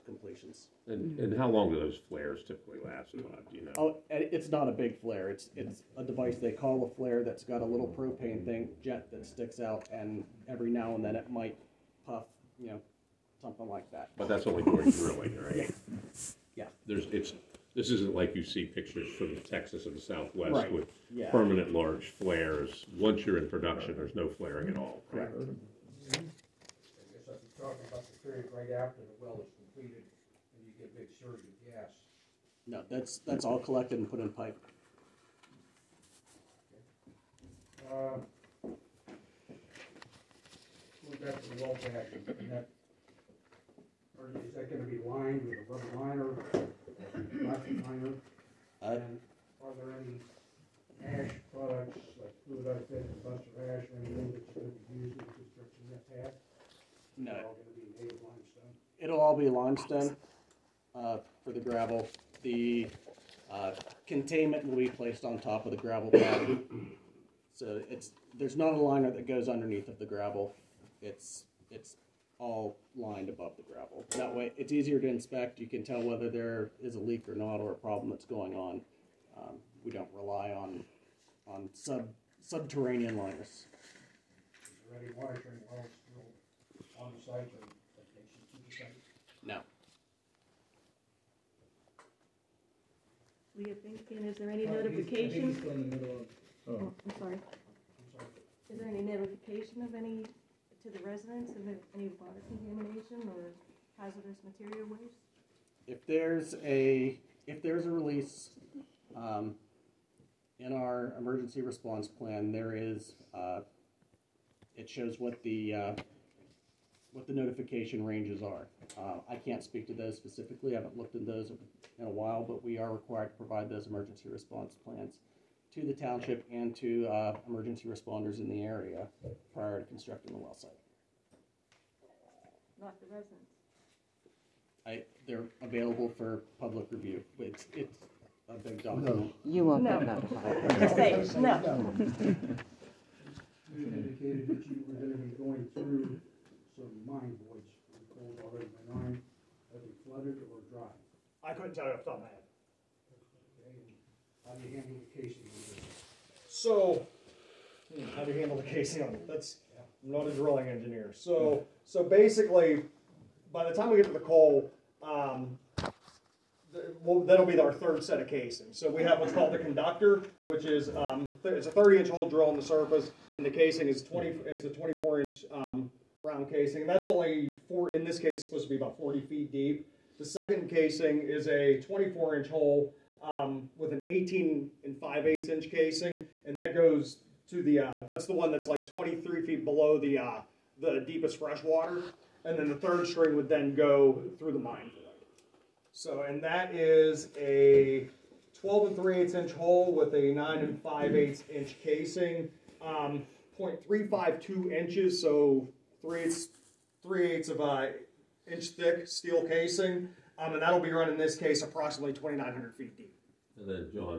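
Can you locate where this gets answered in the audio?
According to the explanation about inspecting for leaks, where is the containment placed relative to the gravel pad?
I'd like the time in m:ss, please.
1:04.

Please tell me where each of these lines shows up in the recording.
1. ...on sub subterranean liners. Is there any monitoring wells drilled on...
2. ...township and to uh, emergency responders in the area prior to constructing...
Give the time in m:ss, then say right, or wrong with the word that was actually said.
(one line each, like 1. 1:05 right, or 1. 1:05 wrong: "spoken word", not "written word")
1. 1:21 right
2. 2:05 right.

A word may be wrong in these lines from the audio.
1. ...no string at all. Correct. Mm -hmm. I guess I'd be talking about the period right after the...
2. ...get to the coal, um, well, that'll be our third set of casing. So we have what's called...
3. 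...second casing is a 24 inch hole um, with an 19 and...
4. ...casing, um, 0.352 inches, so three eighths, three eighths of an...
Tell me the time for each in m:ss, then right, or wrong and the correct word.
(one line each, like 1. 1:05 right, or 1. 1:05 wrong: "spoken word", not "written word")
1. 0:24 wrong: "flaring", not "string"
2. 2:43 right
3. 3:00 wrong: "18", not "19"
4. 3:21 right.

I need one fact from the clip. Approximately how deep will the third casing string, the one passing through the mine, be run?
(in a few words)
2,900 feet.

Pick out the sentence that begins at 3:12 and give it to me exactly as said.
And then the third string would then go through the mine.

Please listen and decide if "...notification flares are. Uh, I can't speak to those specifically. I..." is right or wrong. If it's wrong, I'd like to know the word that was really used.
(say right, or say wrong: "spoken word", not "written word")
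wrong: "ranges", not "flares".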